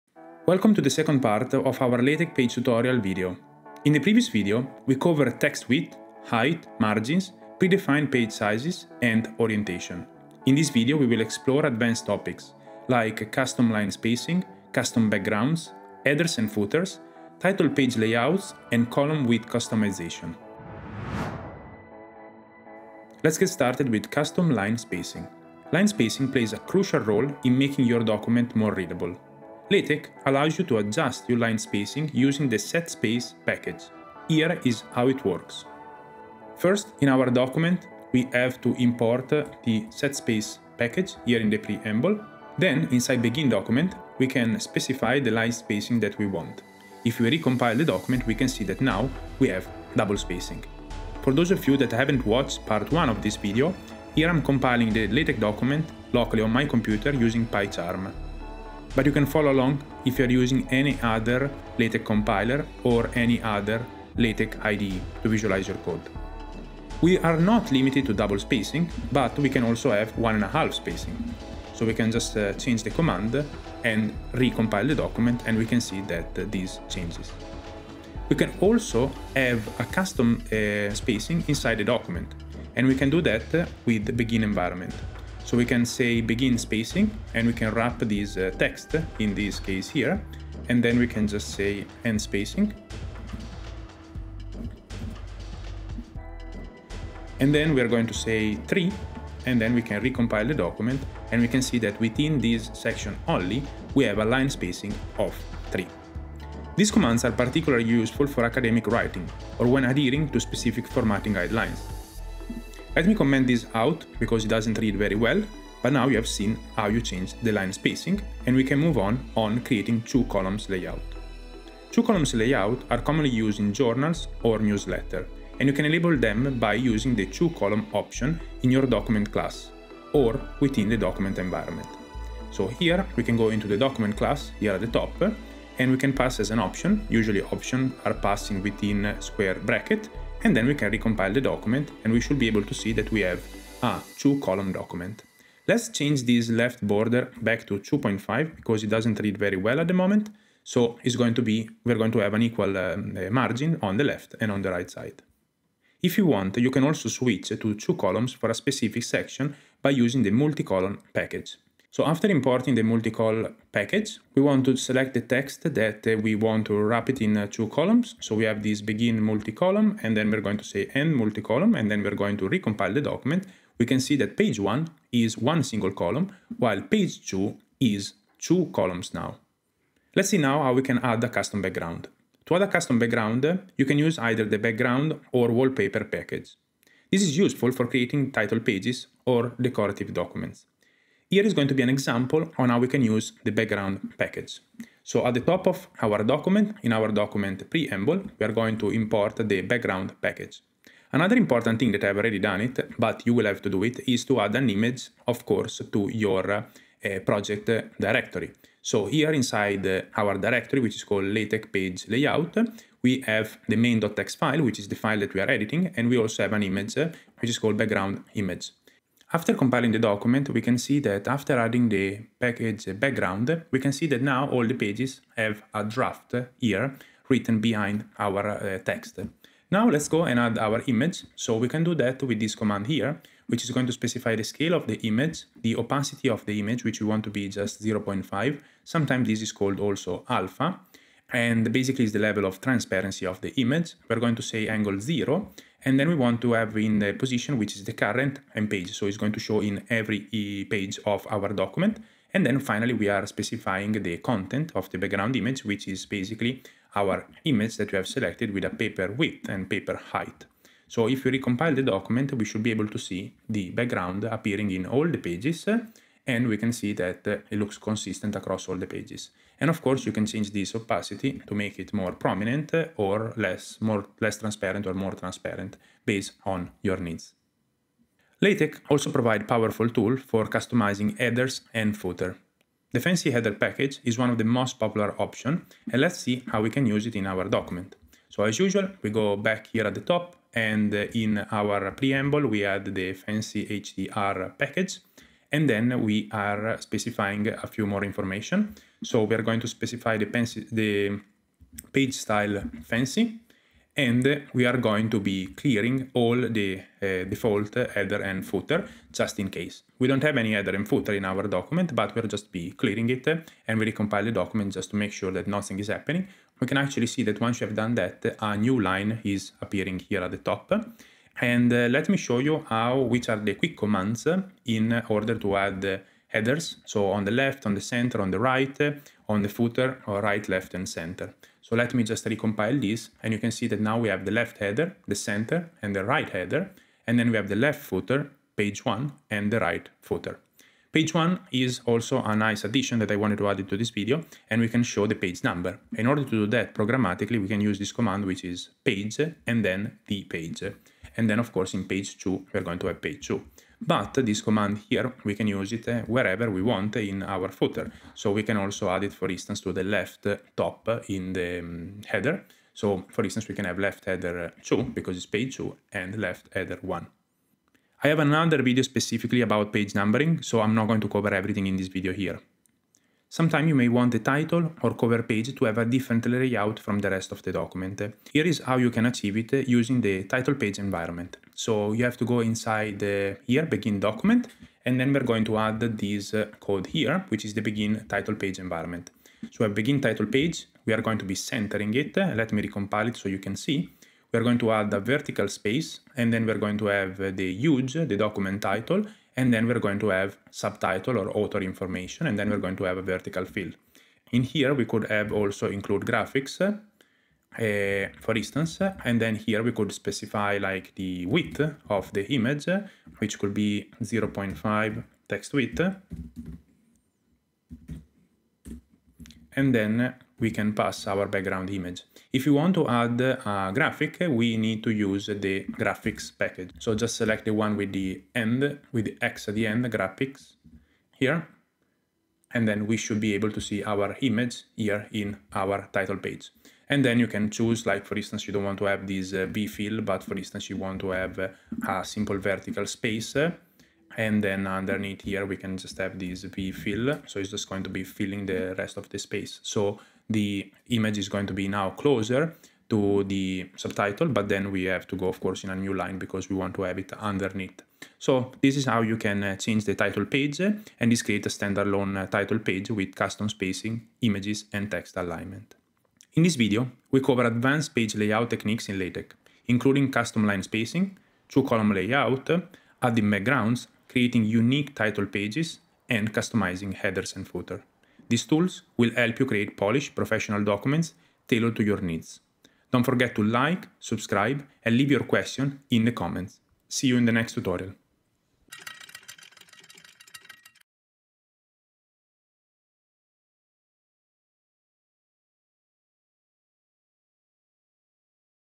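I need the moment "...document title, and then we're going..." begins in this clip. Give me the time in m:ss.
6:38.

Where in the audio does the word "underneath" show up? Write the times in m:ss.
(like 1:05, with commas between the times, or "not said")
7:24, 7:37.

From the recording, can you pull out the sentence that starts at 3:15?
So at the top of our document, in our document preamble, we are going to import the background package.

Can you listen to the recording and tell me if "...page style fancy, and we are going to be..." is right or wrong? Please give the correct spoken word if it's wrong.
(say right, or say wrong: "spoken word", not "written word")
right.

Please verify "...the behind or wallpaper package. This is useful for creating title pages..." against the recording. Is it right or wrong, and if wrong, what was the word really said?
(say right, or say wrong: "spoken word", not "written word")
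wrong: "background", not "behind".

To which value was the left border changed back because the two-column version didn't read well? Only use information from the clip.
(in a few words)
2.5.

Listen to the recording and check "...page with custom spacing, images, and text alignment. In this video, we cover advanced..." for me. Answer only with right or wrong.
right.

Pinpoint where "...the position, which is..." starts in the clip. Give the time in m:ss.
4:06.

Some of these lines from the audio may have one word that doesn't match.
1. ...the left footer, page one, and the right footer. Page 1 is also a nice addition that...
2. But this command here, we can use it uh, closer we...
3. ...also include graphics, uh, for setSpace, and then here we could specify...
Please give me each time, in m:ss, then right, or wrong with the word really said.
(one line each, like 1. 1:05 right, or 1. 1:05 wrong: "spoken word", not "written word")
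1. 5:37 right
2. 5:53 wrong: "wherever", not "closer"
3. 6:45 wrong: "instance", not "setSpace".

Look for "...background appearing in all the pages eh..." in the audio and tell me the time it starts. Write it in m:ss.
4:23.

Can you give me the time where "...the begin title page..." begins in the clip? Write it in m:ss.
6:27.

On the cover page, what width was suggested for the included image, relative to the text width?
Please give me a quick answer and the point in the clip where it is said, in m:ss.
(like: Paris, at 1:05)
0.5 text width, at 6:54.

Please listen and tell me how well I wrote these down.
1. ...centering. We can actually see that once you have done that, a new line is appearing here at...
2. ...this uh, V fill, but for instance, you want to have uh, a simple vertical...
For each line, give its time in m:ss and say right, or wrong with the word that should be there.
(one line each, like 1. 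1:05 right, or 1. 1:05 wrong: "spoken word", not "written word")
1. 5:15 wrong: "happening", not "centering"
2. 7:19 right.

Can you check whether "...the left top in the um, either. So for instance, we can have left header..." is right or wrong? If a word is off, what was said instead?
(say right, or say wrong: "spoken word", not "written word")
wrong: "header", not "either".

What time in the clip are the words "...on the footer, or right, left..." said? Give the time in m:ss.
5:29.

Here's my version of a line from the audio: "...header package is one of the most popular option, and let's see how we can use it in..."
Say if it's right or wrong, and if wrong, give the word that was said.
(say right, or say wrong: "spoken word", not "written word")
right.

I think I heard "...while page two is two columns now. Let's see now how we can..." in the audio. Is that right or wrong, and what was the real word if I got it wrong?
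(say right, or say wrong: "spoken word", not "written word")
right.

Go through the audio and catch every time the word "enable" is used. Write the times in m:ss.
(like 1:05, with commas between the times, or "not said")
2:05.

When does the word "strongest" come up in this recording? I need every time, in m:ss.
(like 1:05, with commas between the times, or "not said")
not said.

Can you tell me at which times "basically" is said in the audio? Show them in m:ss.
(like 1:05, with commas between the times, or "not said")
4:01, 4:16.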